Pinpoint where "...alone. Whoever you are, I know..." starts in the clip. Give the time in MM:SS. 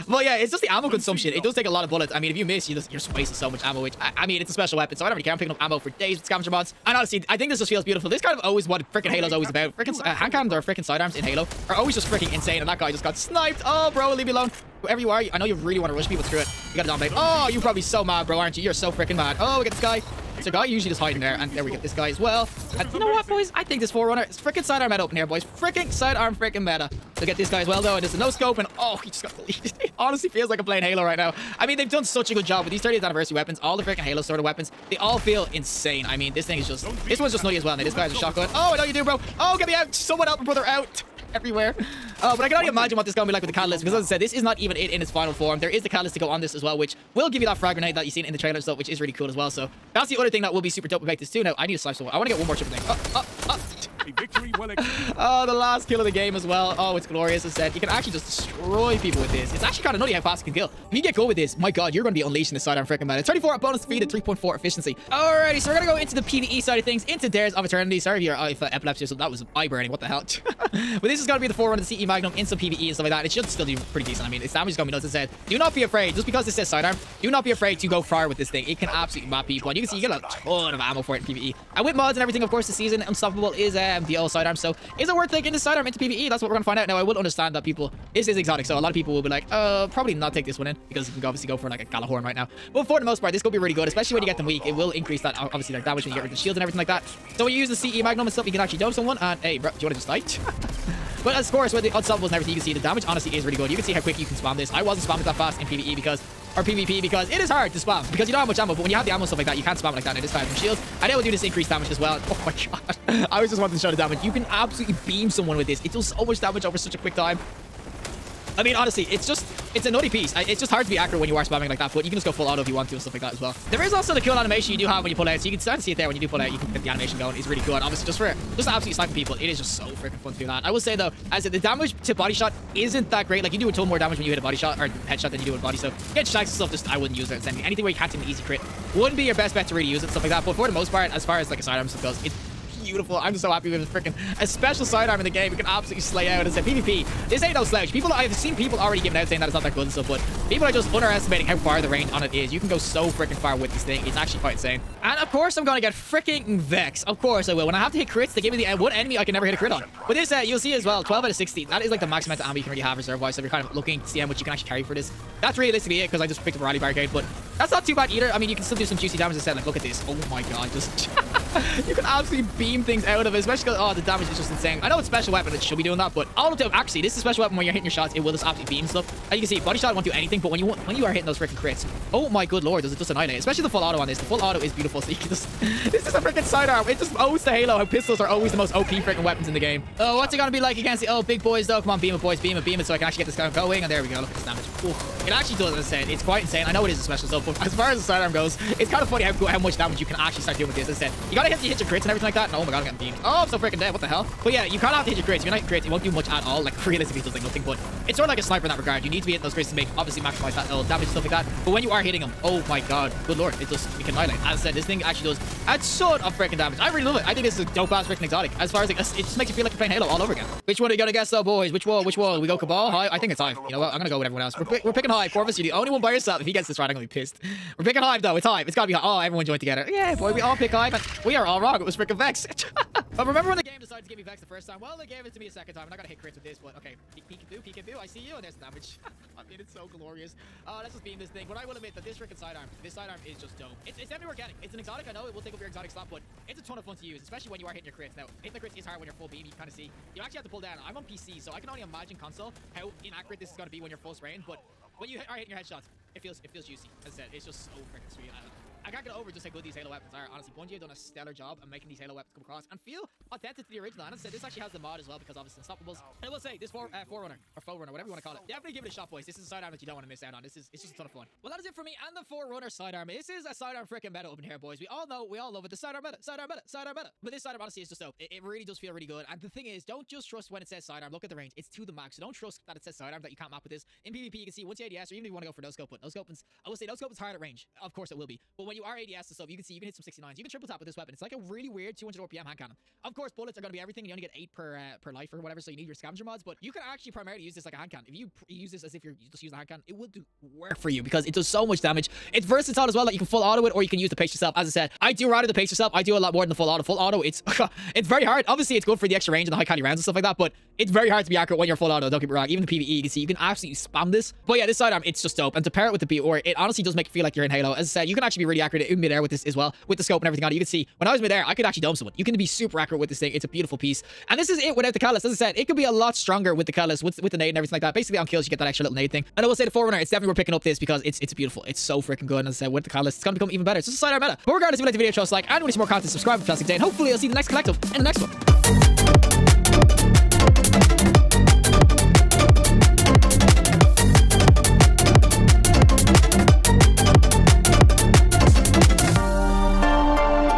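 00:14.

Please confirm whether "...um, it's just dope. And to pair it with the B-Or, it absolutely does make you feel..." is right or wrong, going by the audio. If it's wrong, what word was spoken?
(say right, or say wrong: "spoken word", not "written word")
wrong: "honestly", not "absolutely".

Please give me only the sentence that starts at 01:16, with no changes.
Just because this says sidearm, do not be afraid to go far with this thing.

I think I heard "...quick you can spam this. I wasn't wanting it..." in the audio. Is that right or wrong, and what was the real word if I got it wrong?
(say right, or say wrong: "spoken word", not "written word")
wrong: "spamming", not "wanting".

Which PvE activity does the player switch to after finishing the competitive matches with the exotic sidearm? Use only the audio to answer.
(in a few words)
Dares of Eternity.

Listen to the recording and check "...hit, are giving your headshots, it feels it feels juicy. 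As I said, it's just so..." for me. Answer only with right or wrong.
wrong.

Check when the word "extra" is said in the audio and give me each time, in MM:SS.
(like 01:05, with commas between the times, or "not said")
05:09, 05:28.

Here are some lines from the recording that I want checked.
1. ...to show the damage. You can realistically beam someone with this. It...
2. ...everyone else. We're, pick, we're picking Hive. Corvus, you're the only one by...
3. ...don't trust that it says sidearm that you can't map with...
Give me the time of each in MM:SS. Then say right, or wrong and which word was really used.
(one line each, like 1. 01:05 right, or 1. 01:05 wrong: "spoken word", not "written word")
1. 01:53 wrong: "absolutely", not "realistically"
2. 03:44 right
3. 04:42 right.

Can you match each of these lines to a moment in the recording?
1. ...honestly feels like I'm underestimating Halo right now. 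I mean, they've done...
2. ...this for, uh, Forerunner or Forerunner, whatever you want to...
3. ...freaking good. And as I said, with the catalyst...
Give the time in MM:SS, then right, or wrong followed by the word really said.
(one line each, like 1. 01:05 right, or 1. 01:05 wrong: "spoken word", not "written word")
1. 00:29 wrong: "playing", not "underestimating"
2. 04:26 right
3. 05:32 right.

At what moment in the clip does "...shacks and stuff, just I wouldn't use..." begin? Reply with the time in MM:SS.
02:16.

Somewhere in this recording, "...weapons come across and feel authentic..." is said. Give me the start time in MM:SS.
04:22.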